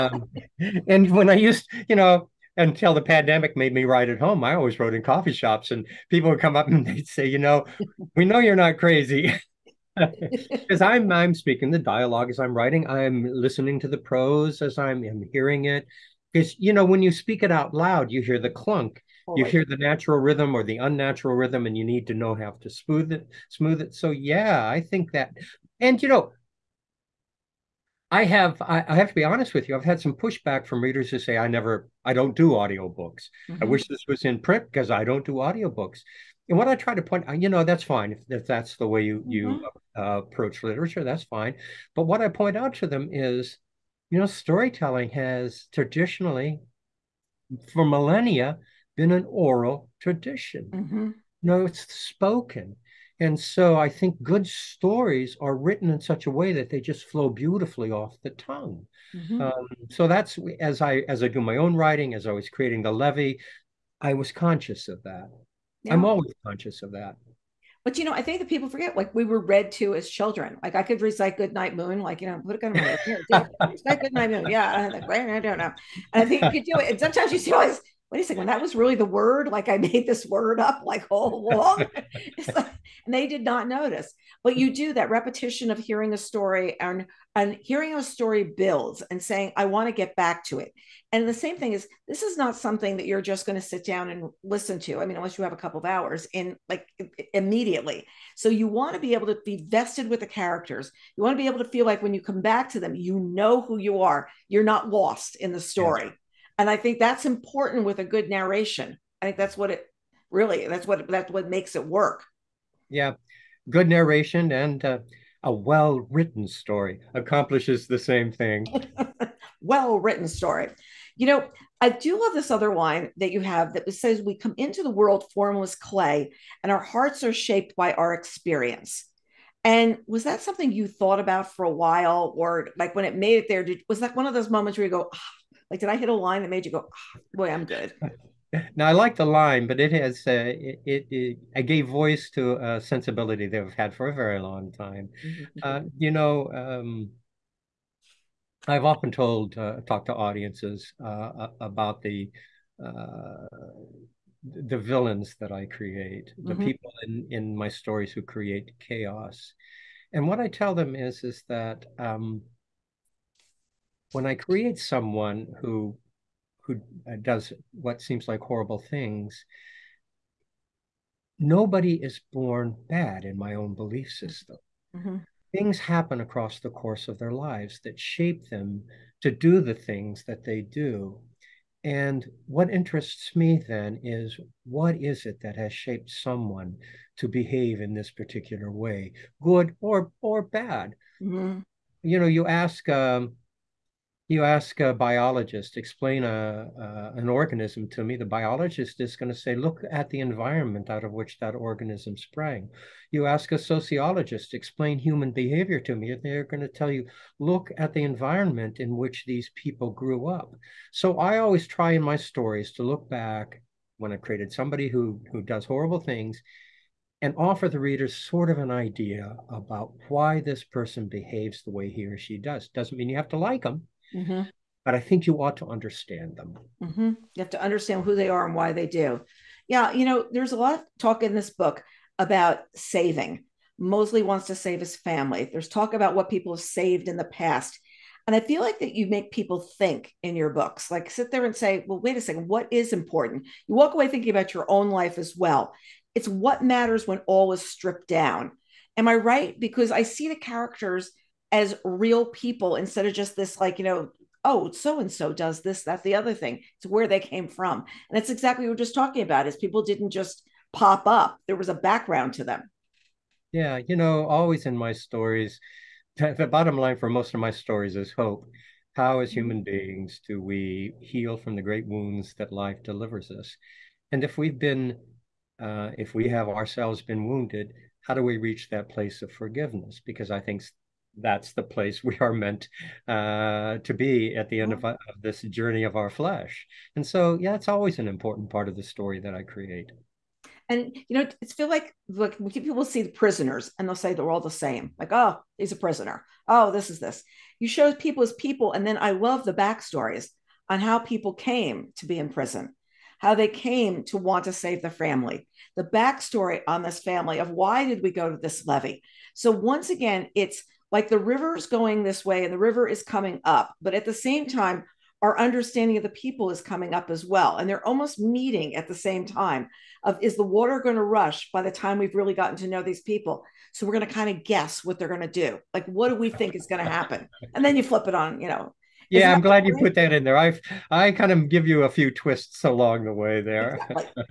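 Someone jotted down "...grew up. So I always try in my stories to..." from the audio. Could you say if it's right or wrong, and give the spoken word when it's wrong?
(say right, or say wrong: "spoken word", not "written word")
right.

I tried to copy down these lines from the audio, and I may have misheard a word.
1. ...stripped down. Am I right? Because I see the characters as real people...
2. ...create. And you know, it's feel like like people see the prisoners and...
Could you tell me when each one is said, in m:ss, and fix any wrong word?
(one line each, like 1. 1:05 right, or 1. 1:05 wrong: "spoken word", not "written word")
1. 4:07 right
2. 4:49 right.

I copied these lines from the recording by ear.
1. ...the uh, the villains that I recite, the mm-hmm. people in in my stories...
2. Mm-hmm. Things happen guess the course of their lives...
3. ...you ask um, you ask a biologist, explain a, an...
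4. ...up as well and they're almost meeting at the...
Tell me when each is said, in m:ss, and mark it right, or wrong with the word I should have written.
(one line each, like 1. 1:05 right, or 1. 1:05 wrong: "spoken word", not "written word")
1. 2:32 wrong: "create", not "recite"
2. 2:54 wrong: "across", not "guess"
3. 3:12 right
4. 5:16 right.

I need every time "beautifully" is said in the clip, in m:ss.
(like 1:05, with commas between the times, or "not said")
0:57.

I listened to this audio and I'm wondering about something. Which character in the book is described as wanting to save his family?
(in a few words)
Mosley.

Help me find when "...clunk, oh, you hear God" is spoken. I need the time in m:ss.
0:18.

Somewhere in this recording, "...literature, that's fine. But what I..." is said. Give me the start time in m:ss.
0:40.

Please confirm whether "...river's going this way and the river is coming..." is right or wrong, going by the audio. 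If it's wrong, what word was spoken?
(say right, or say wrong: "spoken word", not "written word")
right.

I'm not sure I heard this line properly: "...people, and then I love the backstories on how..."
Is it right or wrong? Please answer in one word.
right.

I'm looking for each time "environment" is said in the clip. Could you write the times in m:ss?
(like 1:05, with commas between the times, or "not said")
3:20, 3:28.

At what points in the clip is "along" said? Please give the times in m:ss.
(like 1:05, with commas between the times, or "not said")
1:21, 5:32.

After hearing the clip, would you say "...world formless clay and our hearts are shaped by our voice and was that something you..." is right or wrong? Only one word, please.
wrong.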